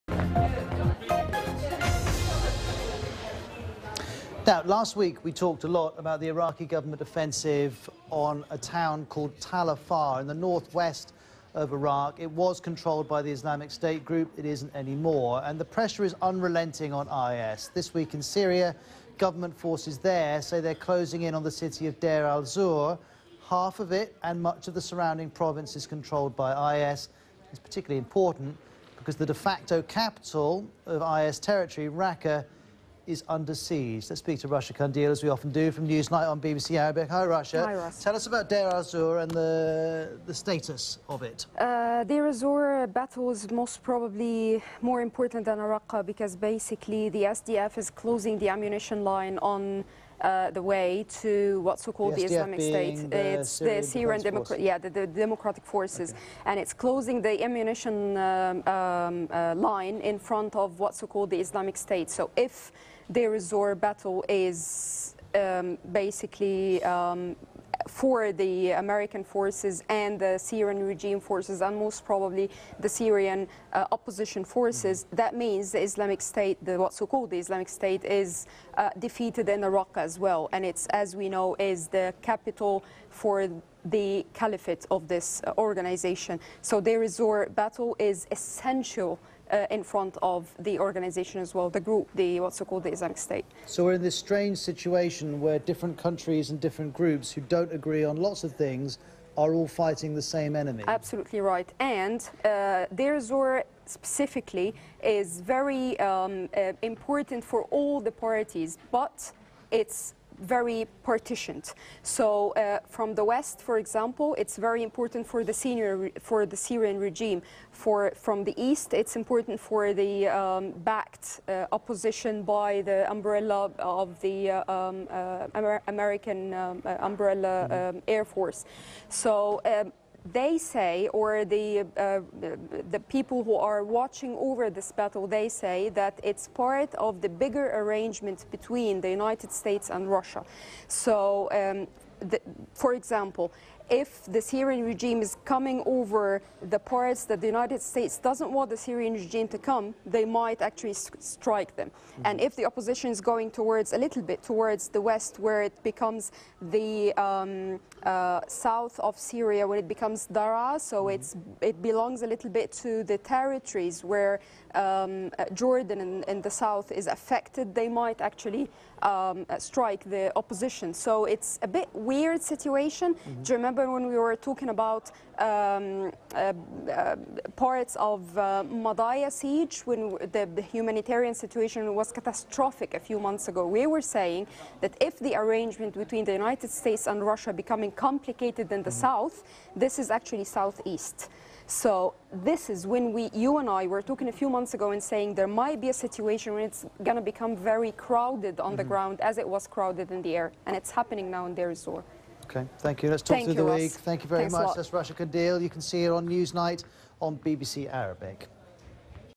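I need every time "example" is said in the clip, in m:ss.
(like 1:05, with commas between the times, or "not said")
1:53, 2:22.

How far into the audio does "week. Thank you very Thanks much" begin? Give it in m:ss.
3:23.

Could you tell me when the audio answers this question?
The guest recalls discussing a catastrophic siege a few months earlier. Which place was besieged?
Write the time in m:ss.
2:58.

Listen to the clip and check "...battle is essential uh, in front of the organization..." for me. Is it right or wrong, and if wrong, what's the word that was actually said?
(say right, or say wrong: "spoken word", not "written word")
right.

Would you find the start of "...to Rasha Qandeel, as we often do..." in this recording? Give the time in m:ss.
0:34.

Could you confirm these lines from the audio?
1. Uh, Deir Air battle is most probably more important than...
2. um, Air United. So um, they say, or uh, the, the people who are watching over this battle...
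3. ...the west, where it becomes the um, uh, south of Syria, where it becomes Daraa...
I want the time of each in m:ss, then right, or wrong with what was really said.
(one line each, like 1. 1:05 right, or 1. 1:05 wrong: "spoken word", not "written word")
1. 0:41 wrong: "Azur", not "Air"
2. 2:07 wrong: "Force", not "United"
3. 2:34 right.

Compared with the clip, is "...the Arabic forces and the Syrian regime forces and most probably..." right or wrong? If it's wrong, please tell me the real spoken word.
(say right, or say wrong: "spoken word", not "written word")
wrong: "American", not "Arabic".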